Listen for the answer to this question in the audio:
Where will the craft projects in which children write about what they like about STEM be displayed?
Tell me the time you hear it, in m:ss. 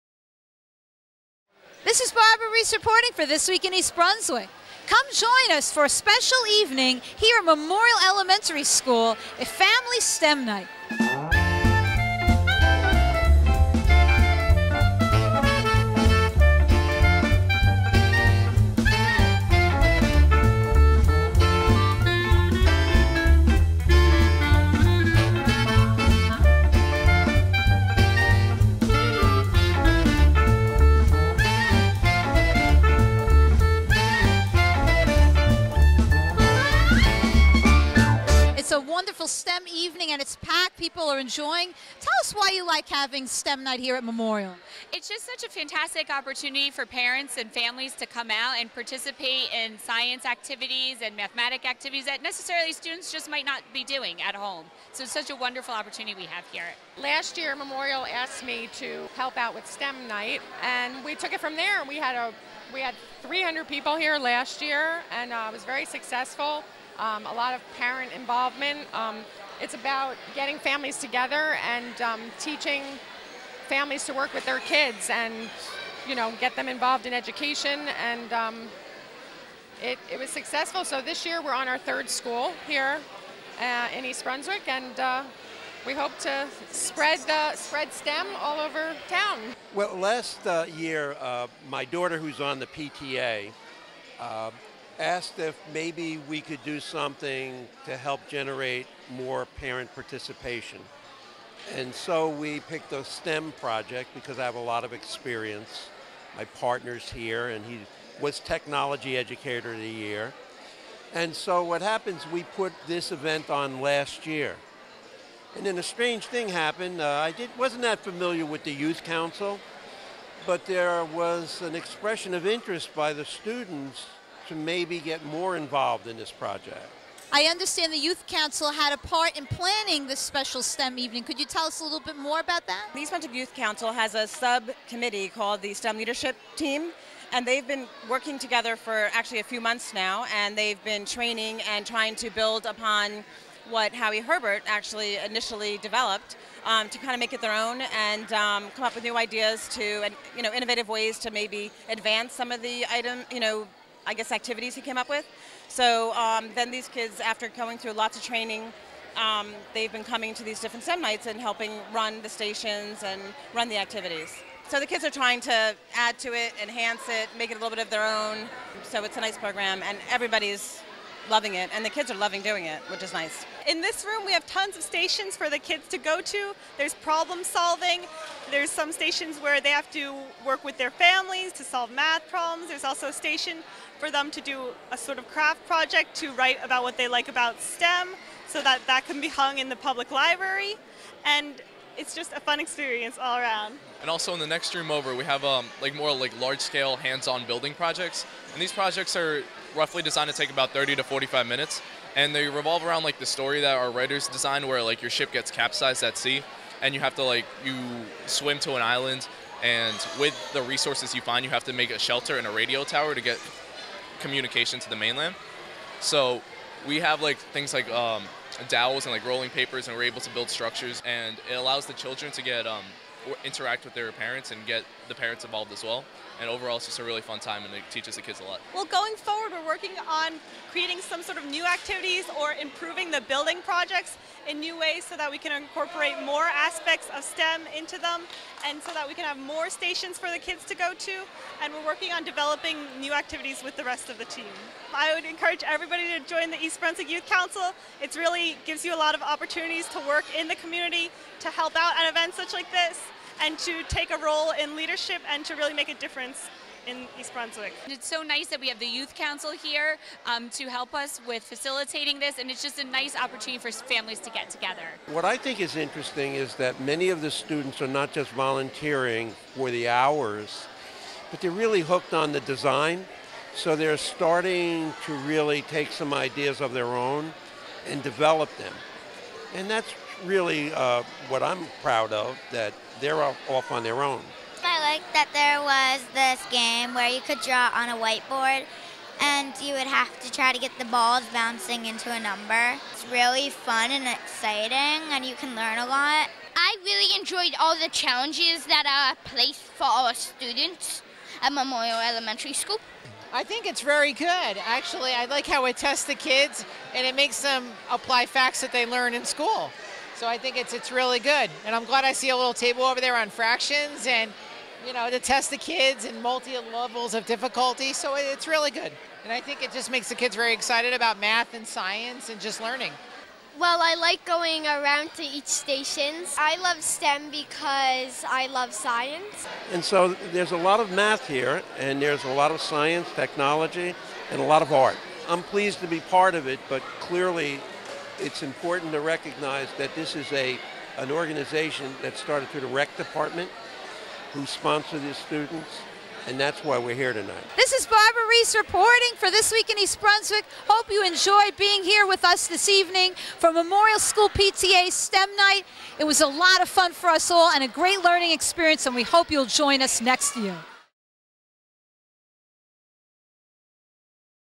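3:09.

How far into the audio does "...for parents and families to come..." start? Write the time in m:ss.
0:46.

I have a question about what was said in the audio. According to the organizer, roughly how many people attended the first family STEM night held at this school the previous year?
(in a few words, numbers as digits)
300.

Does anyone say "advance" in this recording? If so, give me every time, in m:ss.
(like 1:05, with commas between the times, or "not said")
2:31.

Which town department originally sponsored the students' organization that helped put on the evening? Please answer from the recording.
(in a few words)
rec department.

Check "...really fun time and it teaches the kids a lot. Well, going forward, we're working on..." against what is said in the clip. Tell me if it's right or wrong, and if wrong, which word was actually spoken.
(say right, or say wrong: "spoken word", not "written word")
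right.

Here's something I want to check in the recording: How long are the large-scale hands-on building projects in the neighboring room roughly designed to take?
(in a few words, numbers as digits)
30 to 45 minutes.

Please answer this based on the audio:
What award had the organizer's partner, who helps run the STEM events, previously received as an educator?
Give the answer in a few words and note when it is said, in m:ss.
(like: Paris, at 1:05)
Technology Educator of the Year, at 1:48.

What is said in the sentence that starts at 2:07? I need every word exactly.
I understand the Youth Council had a part in planning this special STEM evening.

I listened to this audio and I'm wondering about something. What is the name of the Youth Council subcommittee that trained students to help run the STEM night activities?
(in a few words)
STEM Leadership Team.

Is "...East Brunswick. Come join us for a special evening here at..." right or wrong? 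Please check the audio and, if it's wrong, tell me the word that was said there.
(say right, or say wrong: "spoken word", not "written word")
right.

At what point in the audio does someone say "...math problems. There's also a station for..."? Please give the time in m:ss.
3:01.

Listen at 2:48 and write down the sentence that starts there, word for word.
So it's a nice program, and everybody's loving it, and the kids are loving doing it, which is nice.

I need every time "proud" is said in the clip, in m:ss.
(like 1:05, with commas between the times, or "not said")
4:41.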